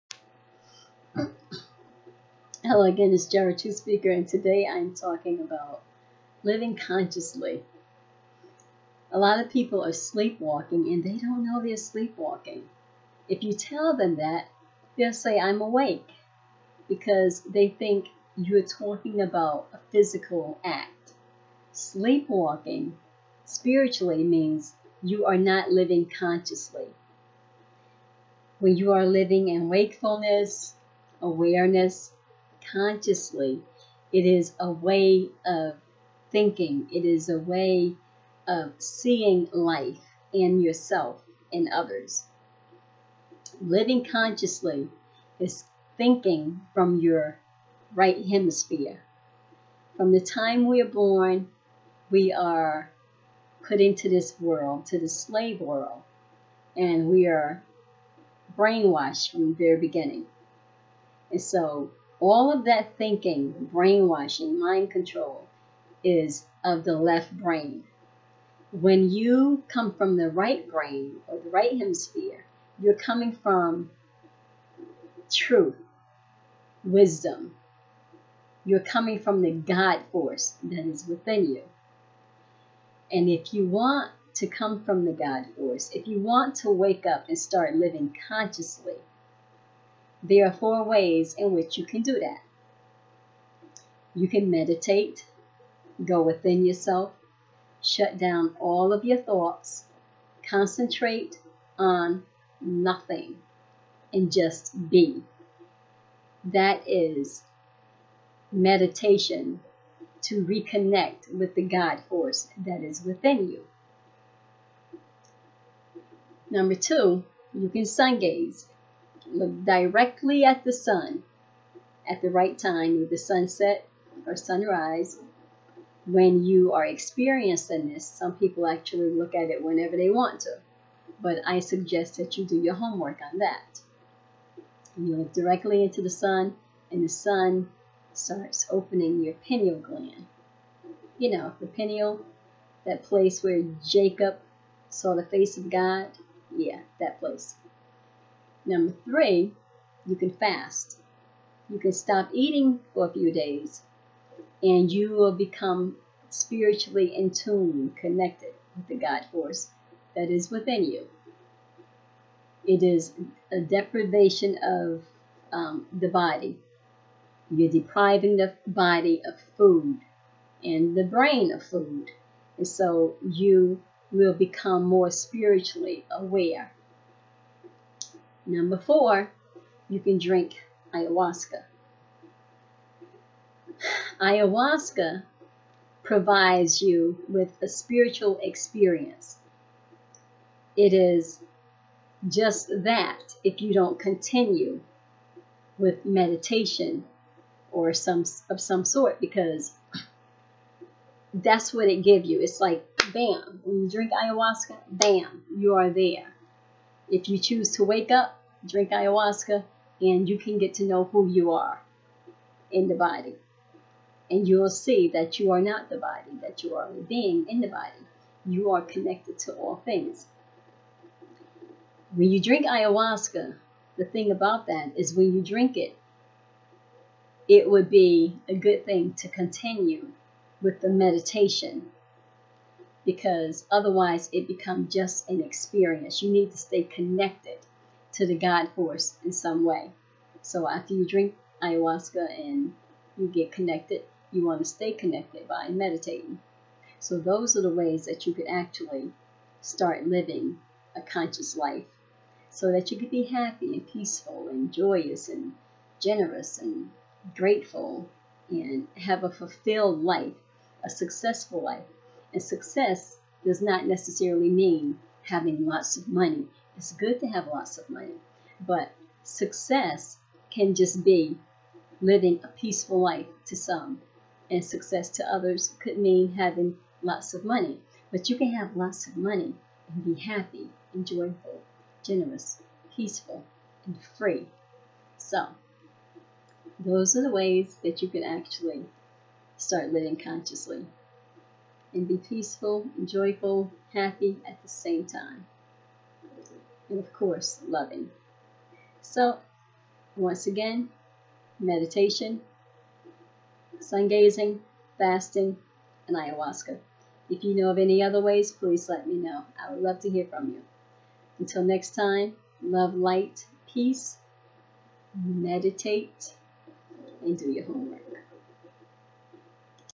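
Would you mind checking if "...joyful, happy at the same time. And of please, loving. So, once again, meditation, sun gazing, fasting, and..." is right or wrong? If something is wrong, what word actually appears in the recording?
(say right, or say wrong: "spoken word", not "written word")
wrong: "course", not "please".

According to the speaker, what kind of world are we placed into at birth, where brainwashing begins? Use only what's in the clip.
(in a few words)
slave world.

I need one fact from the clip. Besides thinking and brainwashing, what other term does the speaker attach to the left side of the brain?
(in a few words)
mind control.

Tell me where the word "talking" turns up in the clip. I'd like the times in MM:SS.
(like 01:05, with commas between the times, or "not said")
00:04, 00:18.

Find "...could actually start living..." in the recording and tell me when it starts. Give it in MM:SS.
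04:08.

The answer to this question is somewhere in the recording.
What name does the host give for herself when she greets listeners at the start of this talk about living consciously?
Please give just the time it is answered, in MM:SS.
00:03.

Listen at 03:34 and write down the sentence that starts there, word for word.
And you'll see that you are not the body, that you are a being in the body.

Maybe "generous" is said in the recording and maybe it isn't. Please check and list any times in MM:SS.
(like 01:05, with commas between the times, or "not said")
04:15, 04:42.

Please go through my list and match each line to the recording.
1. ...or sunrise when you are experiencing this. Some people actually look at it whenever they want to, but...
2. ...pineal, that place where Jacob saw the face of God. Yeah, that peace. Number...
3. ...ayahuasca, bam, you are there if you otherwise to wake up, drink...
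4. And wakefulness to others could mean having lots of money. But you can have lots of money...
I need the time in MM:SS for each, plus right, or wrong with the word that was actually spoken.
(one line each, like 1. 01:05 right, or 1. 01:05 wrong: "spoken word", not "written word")
1. 02:04 right
2. 02:21 wrong: "place", not "peace"
3. 03:24 wrong: "choose", not "otherwise"
4. 04:34 wrong: "success", not "wakefulness".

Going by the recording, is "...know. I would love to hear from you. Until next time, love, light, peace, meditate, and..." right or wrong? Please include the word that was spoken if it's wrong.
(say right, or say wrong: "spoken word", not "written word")
right.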